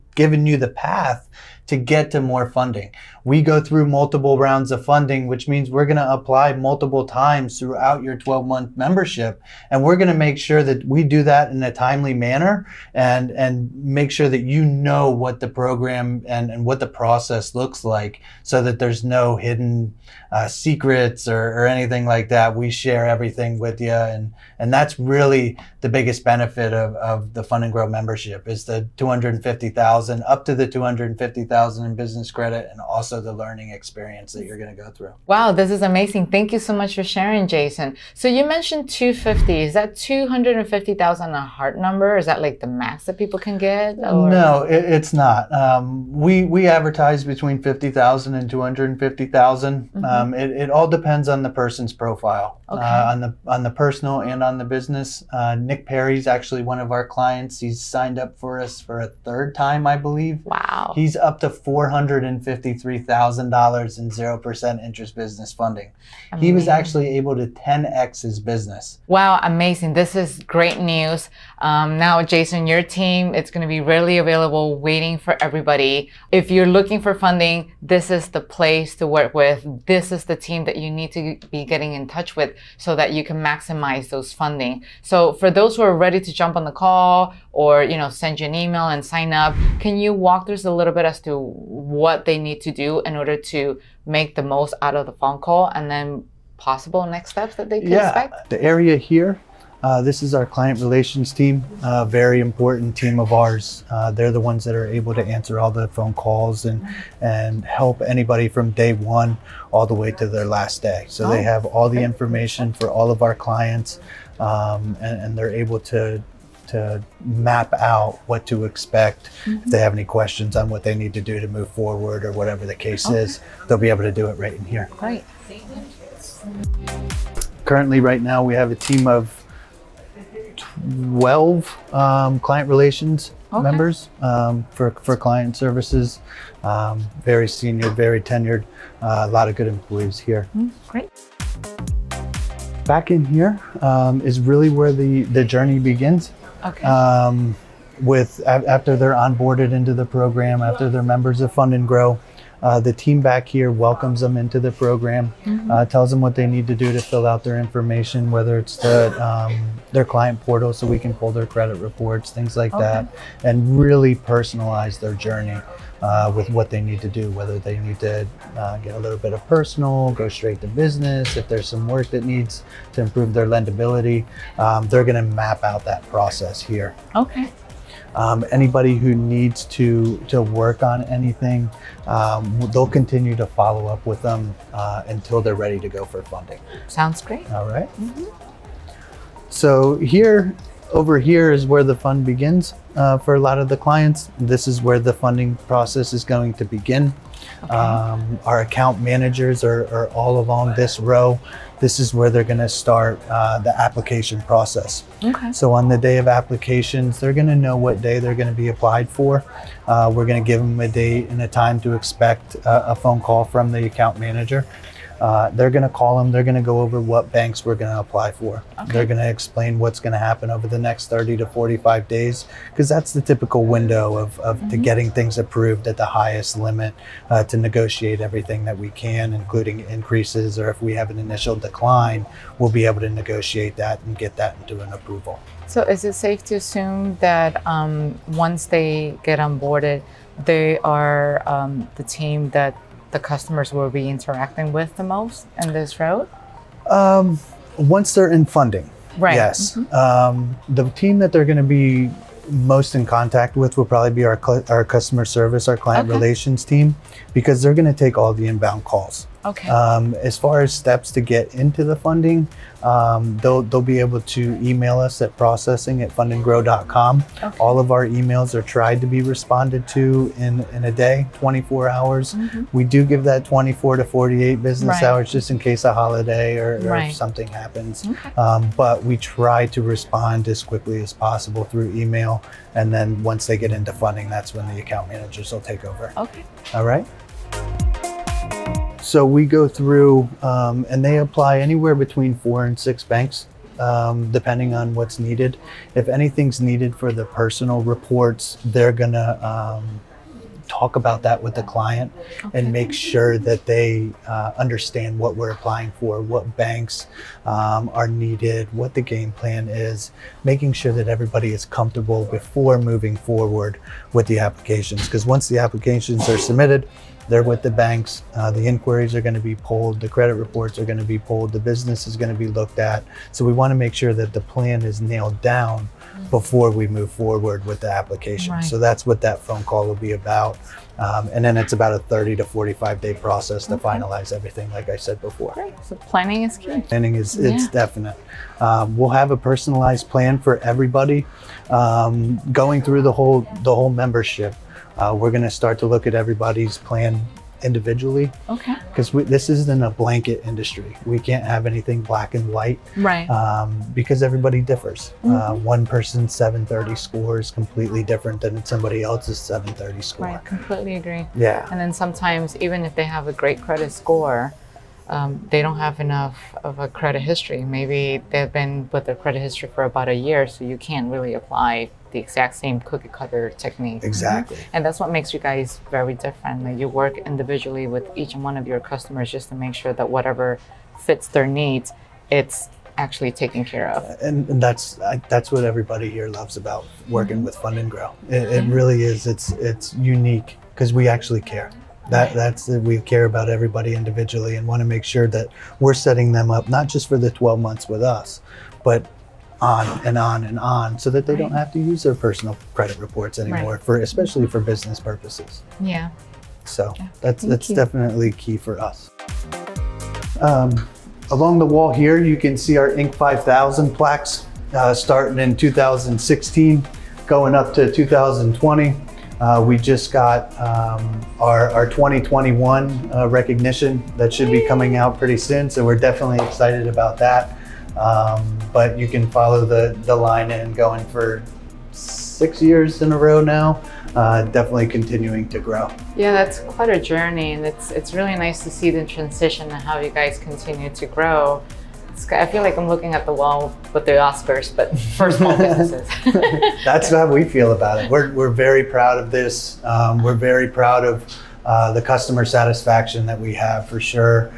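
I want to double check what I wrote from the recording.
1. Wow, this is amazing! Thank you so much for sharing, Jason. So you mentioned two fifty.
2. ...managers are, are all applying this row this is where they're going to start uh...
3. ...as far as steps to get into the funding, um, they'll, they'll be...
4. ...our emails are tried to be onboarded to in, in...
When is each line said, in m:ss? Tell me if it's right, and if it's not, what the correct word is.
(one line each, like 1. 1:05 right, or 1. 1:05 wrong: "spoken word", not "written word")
1. 0:35 right
2. 3:19 wrong: "along", not "applying"
3. 4:20 right
4. 4:27 wrong: "responded", not "onboarded".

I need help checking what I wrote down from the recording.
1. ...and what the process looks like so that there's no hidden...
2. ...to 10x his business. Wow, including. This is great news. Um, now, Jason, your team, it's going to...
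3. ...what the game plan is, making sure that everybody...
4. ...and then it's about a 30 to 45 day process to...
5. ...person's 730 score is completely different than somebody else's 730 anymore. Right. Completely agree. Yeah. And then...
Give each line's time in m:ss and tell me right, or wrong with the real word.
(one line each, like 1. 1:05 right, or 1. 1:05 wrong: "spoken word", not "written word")
1. 0:16 right
2. 1:07 wrong: "amazing", not "including"
3. 5:08 right
4. 5:31 right
5. 5:55 wrong: "score", not "anymore".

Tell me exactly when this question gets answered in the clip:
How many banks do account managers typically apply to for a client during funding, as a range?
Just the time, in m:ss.
4:52.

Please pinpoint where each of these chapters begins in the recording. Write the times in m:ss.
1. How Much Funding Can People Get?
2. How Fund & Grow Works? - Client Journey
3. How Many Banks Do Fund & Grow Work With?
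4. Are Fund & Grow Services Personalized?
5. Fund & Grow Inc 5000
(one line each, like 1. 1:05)
1. 0:35
2. 1:25
3. 4:48
4. 5:39
5. 6:50.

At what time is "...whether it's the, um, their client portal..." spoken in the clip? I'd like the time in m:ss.
2:38.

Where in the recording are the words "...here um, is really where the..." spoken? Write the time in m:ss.
2:23.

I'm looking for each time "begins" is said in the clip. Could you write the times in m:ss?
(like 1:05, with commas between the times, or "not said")
2:25, 3:12, 3:16.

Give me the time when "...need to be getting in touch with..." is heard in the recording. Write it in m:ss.
1:20.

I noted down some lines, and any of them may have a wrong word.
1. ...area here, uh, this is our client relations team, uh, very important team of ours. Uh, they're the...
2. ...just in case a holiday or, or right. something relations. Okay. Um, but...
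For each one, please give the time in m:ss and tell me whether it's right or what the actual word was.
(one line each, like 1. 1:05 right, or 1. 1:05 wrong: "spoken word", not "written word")
1. 1:38 right
2. 4:35 wrong: "happens", not "relations".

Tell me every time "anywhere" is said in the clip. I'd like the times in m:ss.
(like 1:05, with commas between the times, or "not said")
4:51.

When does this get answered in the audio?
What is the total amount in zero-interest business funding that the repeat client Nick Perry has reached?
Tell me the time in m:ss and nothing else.
1:01.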